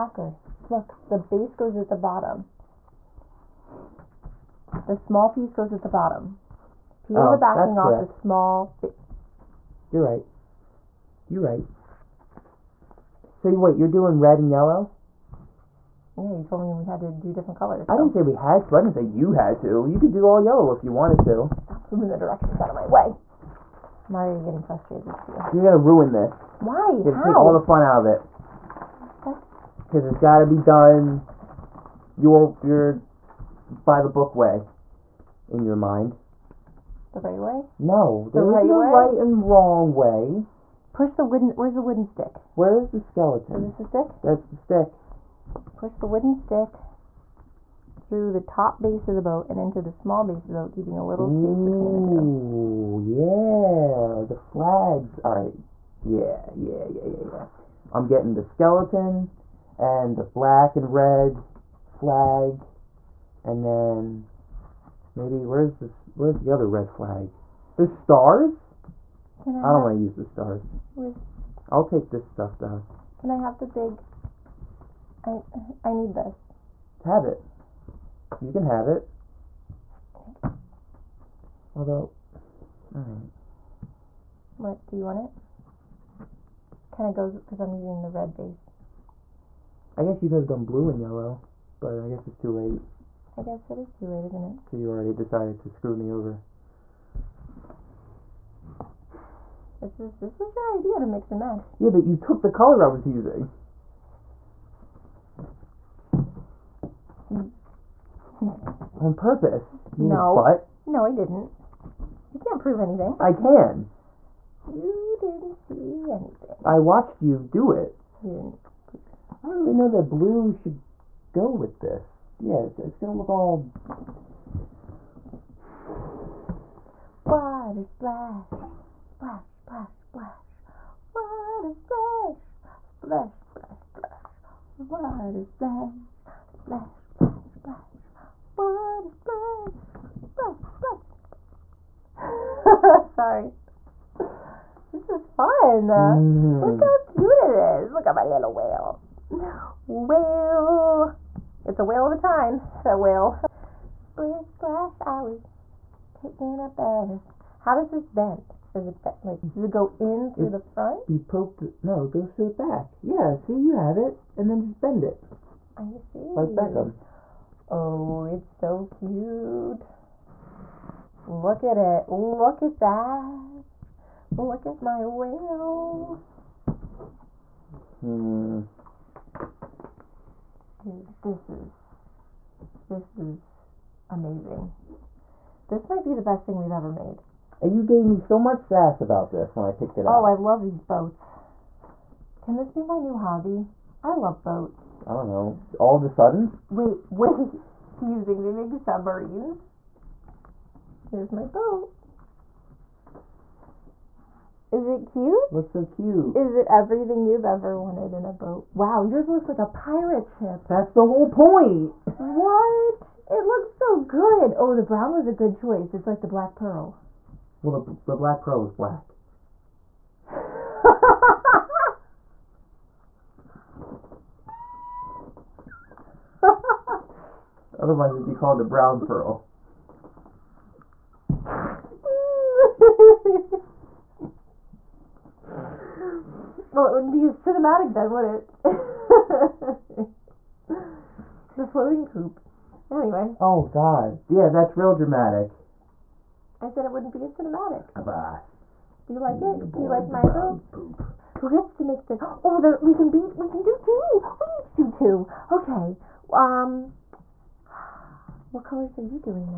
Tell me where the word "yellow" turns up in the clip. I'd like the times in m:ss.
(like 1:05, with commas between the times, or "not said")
0:14, 0:20, 1:31.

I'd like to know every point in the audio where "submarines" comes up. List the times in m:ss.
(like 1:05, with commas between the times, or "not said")
3:18.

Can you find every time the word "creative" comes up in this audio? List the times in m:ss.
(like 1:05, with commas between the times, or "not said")
not said.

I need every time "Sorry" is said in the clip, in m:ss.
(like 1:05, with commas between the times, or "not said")
2:23.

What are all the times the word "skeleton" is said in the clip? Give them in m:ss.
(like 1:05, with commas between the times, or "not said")
0:42, 0:58.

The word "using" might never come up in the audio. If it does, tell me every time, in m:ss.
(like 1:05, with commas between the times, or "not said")
1:27, 1:43.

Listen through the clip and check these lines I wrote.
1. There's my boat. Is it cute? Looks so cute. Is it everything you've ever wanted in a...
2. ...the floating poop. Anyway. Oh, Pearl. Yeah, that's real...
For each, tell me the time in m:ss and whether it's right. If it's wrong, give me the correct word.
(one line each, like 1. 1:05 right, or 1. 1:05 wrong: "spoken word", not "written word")
1. 3:21 right
2. 4:01 wrong: "God", not "Pearl".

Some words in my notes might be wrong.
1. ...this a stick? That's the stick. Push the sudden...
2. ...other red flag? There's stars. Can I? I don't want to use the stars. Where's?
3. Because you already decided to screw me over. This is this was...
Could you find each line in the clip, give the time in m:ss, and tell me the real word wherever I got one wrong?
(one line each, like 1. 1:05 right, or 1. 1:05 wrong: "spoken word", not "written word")
1. 0:43 wrong: "wooden", not "sudden"
2. 1:06 right
3. 1:34 right.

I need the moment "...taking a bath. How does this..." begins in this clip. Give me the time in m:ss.
2:36.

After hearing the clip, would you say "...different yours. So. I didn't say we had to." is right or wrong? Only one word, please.
wrong.